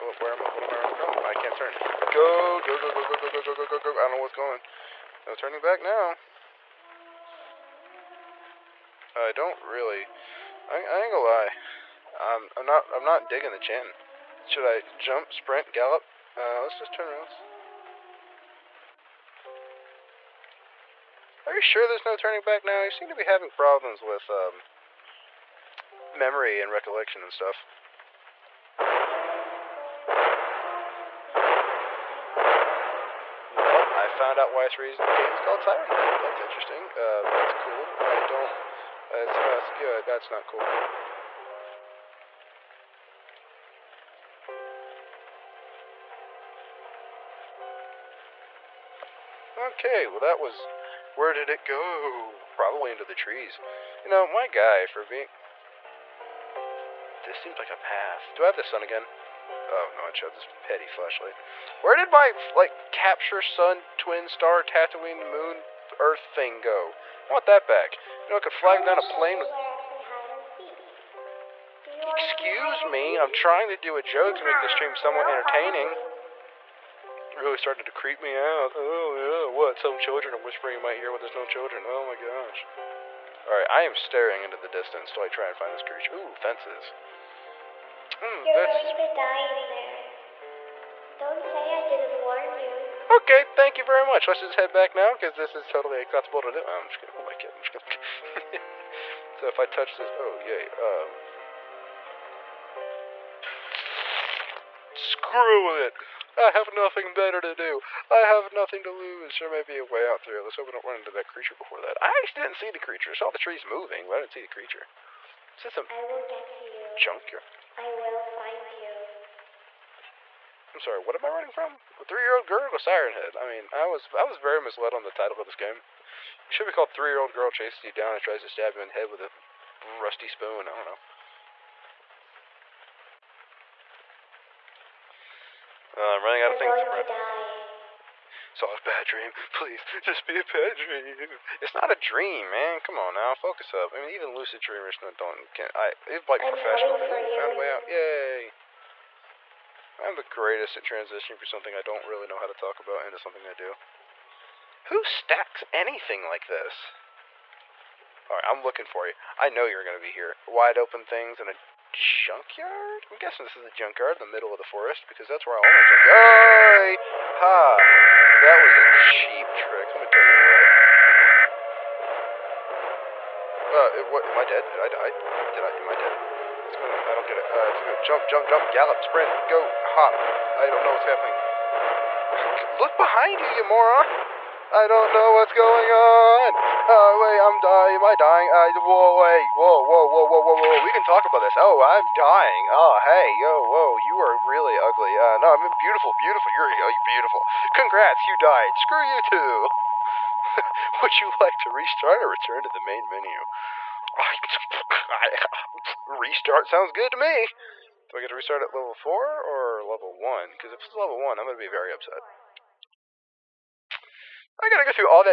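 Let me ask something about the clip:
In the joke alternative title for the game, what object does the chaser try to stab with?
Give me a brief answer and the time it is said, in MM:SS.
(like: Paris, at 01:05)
rusty spoon, at 02:09.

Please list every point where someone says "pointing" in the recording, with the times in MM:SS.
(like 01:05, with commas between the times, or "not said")
not said.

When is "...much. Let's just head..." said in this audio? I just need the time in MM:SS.
01:34.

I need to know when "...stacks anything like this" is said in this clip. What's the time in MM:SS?
02:35.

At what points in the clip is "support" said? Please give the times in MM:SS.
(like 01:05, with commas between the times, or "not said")
not said.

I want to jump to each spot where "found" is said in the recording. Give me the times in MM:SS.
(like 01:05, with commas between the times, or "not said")
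00:34, 02:26.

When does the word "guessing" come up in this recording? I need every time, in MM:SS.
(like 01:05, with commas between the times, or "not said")
02:43.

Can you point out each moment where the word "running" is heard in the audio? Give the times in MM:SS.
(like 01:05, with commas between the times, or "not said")
02:01, 02:16.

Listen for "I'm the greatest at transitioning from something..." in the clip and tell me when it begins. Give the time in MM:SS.
02:29.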